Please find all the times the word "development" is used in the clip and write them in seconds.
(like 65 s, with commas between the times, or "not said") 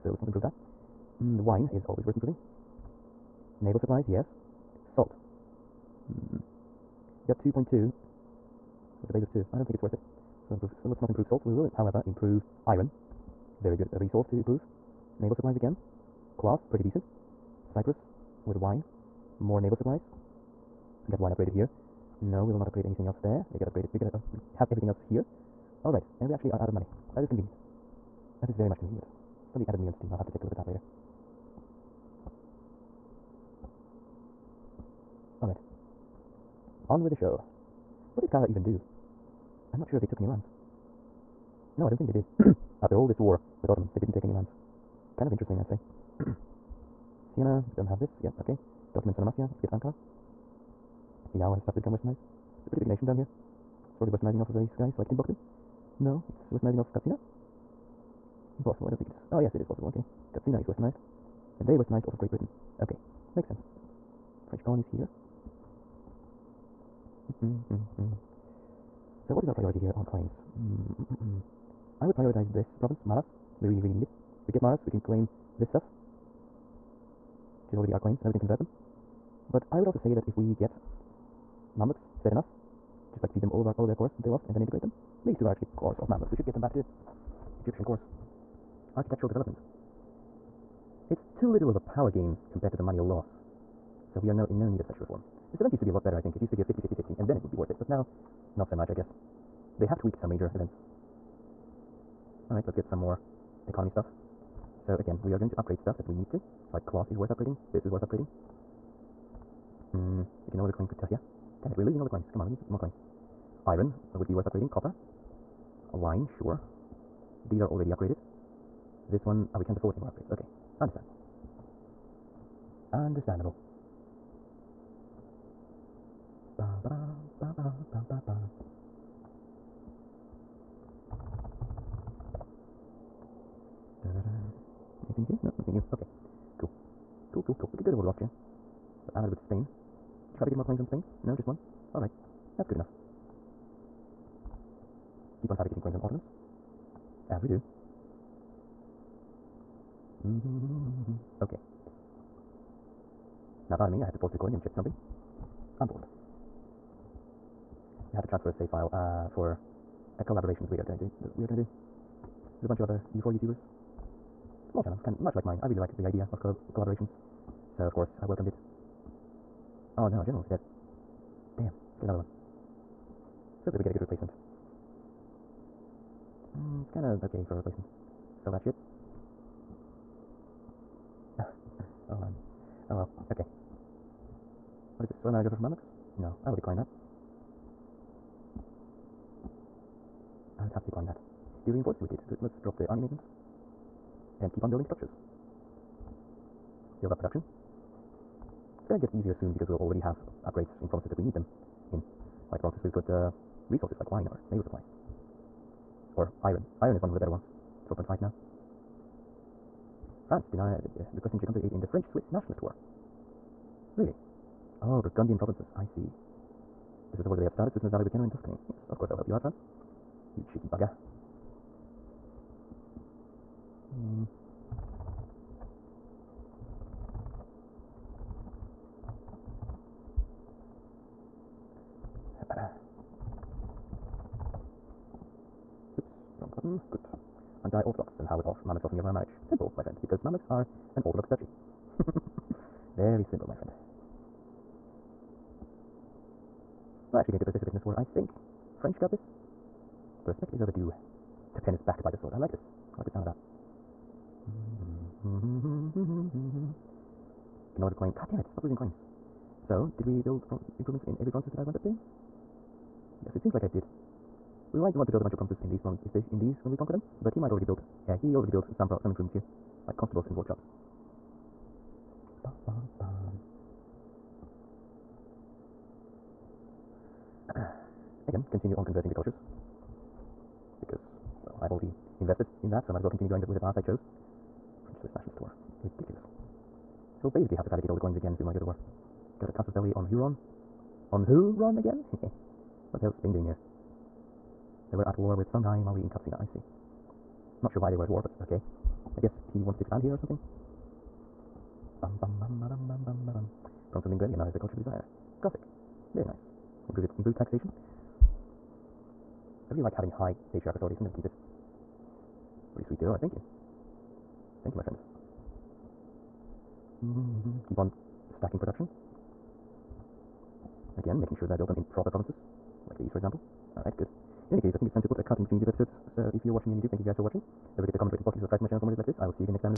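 89 s.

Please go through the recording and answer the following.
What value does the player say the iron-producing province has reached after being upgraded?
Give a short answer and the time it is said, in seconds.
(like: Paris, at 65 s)
4.5, at 207 s.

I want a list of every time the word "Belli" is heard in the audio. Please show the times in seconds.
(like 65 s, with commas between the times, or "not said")
289 s.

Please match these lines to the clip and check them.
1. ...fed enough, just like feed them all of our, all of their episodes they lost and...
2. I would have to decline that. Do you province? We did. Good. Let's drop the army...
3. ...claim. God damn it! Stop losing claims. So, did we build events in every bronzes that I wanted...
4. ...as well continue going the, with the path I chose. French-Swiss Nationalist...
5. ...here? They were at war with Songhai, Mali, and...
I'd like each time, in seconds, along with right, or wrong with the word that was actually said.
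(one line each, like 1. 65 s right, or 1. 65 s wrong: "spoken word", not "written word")
1. 82 s wrong: "cores", not "episodes"
2. 190 s wrong: "reinforce", not "province"
3. 257 s wrong: "improvements", not "events"
4. 283 s right
5. 293 s right.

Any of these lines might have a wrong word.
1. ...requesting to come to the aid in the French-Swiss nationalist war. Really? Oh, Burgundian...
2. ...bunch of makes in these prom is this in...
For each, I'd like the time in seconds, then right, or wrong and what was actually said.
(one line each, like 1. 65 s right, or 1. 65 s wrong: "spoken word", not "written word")
1. 211 s right
2. 265 s wrong: "promises", not "makes".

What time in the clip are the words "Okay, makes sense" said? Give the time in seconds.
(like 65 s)
62 s.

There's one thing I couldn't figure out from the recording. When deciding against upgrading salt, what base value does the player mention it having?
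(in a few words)
2.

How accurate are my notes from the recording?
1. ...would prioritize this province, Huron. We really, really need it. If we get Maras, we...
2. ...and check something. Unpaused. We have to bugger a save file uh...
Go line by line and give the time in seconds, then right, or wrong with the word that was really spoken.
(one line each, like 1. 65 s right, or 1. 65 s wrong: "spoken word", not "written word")
1. 72 s wrong: "Maras", not "Huron"
2. 154 s wrong: "transfer", not "bugger".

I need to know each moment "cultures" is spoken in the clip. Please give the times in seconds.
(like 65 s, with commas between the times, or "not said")
279 s, 304 s.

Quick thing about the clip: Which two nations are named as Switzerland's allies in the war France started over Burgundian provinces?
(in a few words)
Genoa and Tuscany.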